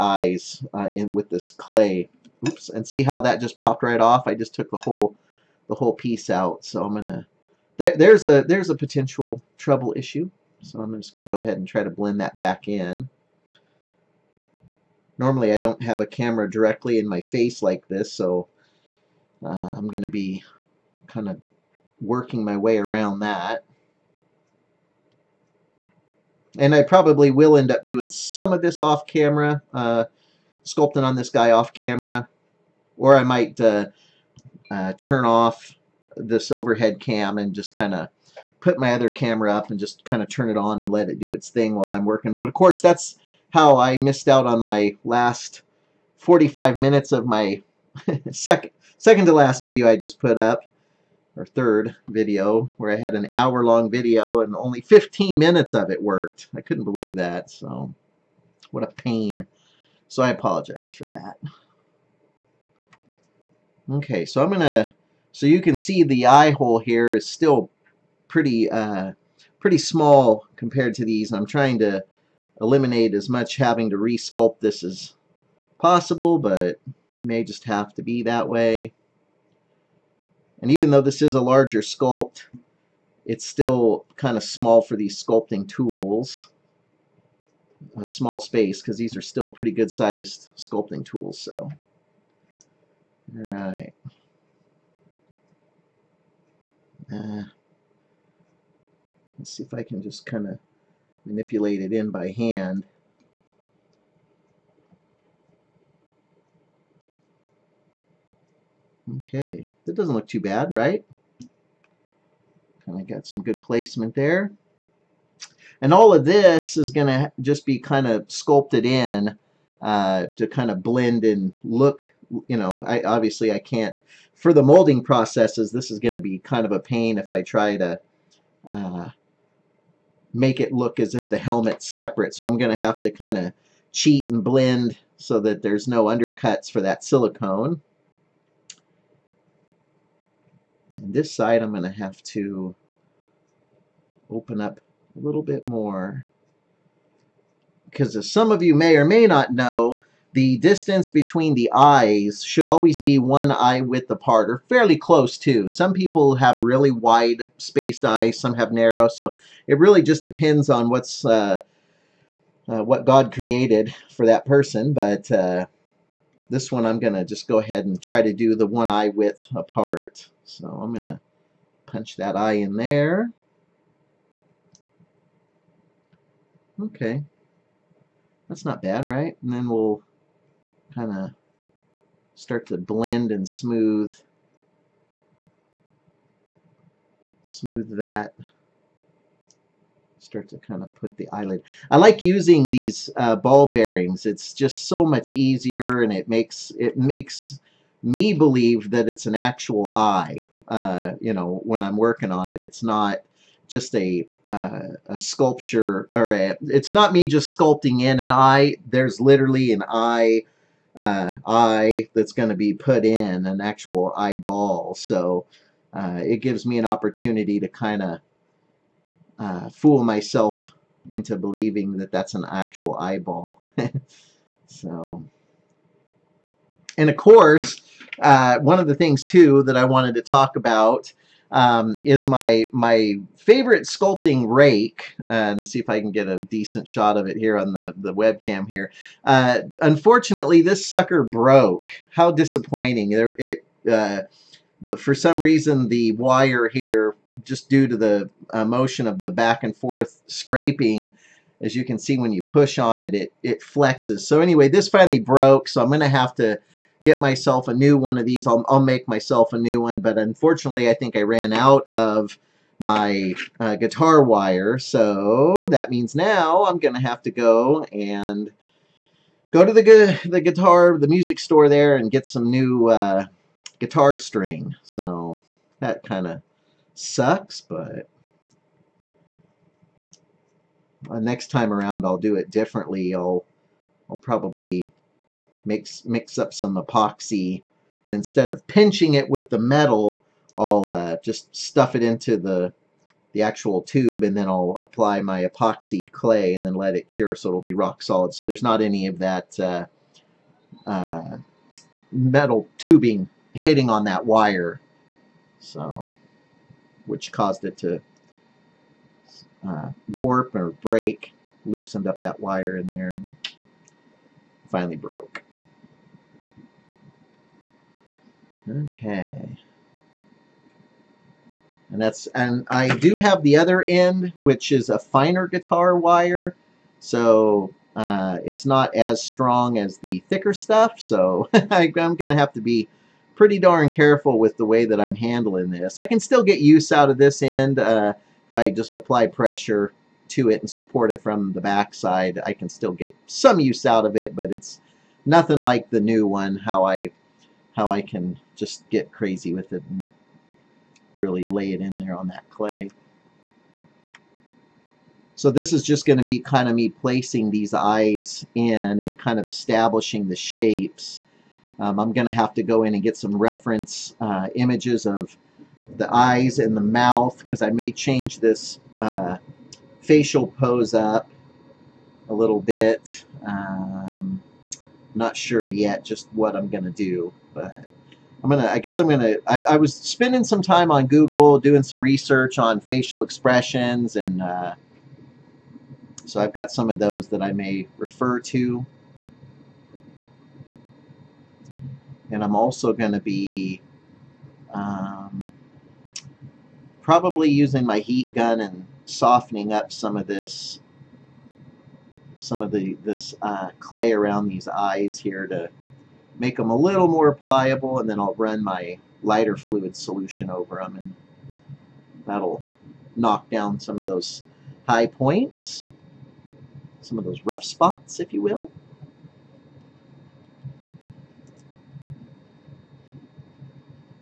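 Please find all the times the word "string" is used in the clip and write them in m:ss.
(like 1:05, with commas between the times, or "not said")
4:34.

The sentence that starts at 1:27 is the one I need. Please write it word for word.
A small space because these are still pretty good sized sculpting tools.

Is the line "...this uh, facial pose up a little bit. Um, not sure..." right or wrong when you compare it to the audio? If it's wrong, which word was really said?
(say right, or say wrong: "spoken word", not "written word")
right.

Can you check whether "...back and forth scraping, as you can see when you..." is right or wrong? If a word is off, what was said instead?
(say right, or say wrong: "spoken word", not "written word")
right.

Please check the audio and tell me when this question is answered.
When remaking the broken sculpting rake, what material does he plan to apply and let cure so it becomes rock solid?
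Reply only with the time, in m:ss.
4:55.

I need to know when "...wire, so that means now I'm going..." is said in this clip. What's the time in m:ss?
4:24.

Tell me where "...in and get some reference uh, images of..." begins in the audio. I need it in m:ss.
6:02.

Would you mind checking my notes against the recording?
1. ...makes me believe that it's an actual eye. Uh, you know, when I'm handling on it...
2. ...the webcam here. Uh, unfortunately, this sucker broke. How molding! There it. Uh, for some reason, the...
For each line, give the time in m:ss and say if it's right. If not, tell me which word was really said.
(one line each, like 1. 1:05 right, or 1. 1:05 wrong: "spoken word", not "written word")
1. 3:16 wrong: "working", not "handling"
2. 3:57 wrong: "disappointing", not "molding".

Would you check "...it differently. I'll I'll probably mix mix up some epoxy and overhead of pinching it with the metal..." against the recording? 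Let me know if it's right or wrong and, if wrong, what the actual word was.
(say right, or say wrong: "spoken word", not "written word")
wrong: "instead", not "overhead".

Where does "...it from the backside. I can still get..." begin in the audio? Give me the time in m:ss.
5:41.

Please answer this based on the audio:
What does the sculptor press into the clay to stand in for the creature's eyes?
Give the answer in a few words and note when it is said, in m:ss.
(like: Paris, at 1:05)
ball bearings, at 3:13.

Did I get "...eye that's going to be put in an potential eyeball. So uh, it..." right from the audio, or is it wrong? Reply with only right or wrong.
wrong.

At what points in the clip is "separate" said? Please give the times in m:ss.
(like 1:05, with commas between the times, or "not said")
2:11.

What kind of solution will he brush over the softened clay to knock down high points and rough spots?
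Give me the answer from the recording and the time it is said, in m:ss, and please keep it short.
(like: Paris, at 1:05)
lighter fluid, at 6:49.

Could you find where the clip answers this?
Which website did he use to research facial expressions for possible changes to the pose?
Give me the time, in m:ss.
6:21.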